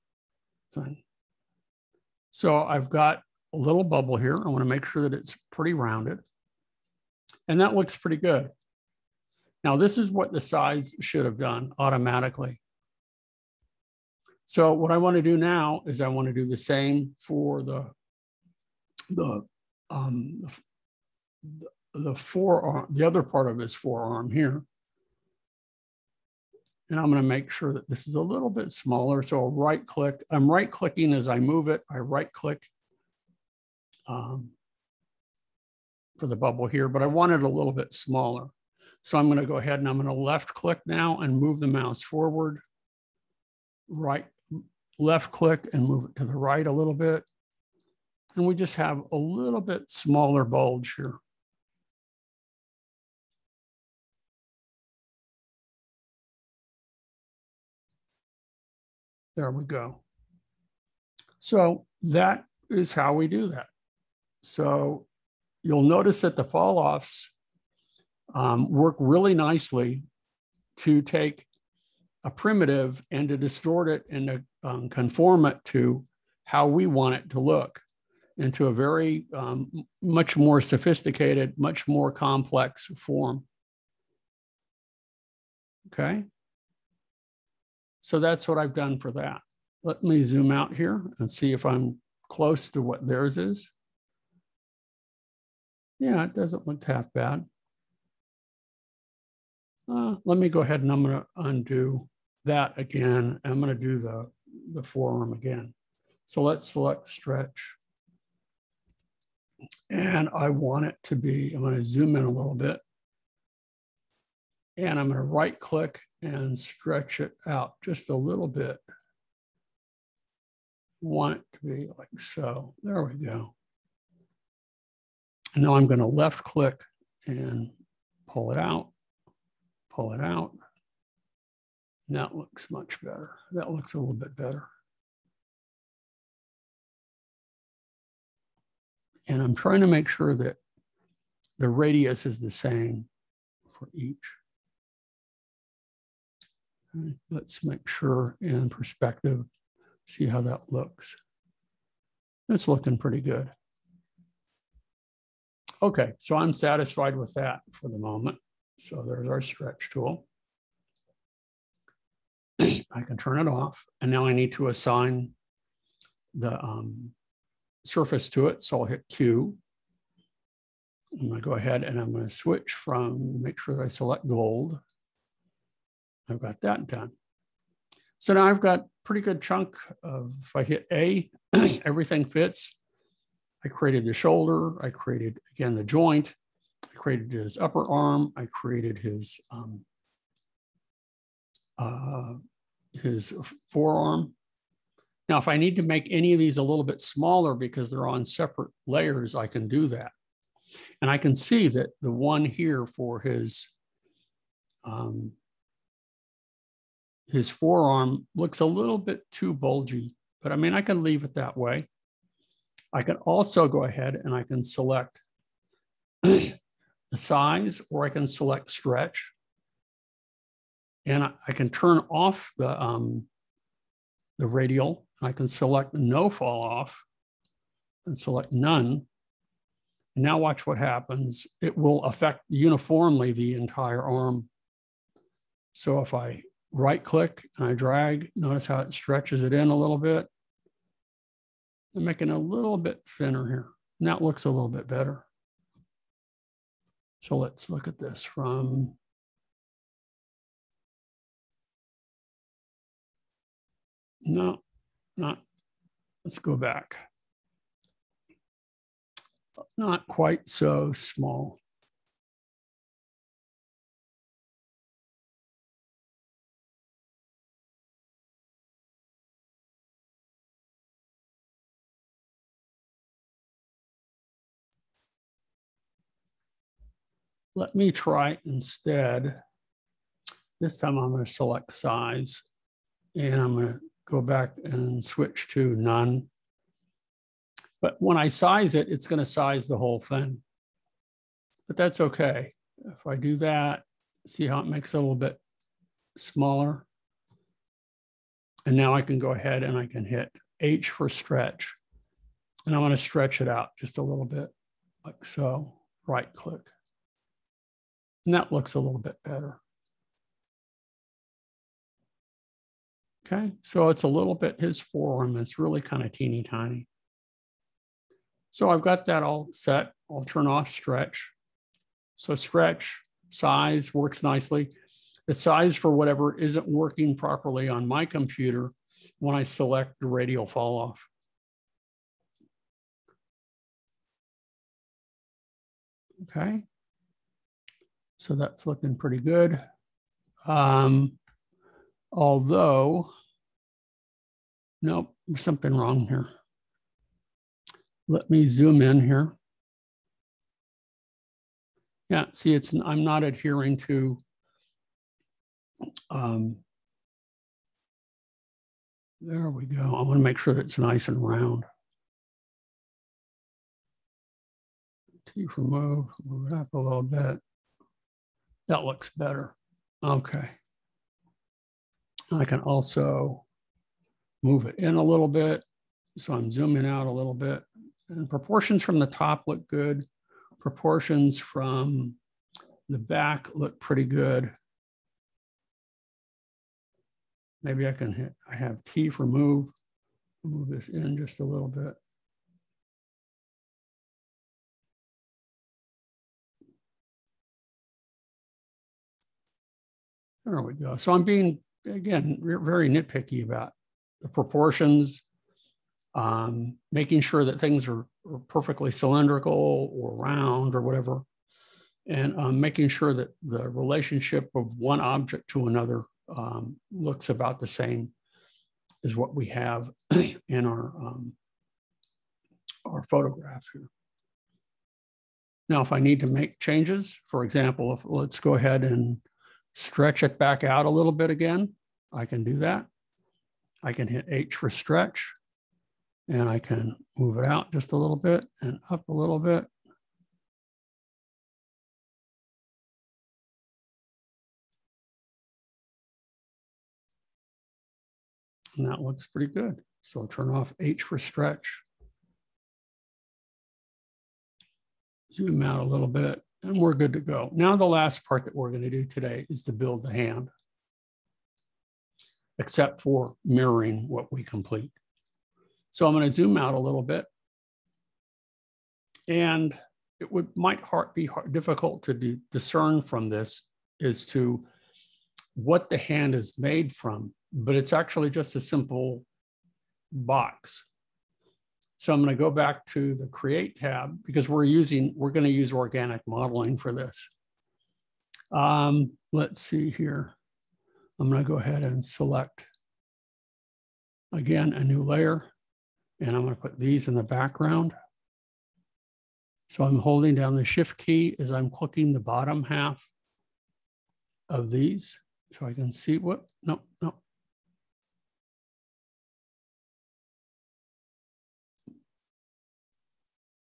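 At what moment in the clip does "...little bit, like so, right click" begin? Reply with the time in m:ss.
5:04.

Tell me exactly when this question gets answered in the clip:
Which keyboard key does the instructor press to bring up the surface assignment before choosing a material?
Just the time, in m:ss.
2:49.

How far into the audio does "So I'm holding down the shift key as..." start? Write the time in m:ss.
8:19.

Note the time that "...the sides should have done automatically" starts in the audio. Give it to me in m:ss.
0:10.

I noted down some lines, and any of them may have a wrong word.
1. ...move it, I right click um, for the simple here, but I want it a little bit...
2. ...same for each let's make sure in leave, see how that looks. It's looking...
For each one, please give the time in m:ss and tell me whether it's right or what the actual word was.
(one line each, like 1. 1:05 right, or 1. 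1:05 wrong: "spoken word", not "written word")
1. 0:31 wrong: "bubble", not "simple"
2. 2:22 wrong: "perspective", not "leave".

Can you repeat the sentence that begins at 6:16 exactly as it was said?
So I'm zooming out a little bit.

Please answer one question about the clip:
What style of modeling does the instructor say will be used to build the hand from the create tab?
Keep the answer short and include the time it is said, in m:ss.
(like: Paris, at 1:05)
Organic modeling, at 8:05.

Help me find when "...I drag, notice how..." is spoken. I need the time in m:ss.
3:57.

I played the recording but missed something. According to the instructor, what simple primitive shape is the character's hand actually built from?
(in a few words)
A simple box.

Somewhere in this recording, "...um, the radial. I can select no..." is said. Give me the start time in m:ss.
3:42.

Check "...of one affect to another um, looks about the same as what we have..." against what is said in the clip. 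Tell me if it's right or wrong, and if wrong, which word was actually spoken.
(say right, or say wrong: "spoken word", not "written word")
wrong: "object", not "affect".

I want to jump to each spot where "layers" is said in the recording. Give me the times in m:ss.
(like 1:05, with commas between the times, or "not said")
3:18, 8:15.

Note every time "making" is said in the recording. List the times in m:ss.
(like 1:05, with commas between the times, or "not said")
4:02, 6:46, 6:52.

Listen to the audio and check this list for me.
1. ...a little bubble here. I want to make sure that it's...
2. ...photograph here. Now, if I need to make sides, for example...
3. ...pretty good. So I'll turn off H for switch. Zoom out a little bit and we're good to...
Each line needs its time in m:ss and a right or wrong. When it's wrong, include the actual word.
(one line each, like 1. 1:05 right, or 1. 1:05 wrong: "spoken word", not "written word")
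1. 0:03 right
2. 7:03 wrong: "changes", not "sides"
3. 7:29 wrong: "stretch", not "switch".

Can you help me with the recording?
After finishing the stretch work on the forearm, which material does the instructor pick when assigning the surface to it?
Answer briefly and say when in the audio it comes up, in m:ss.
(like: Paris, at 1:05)
Gold, at 2:54.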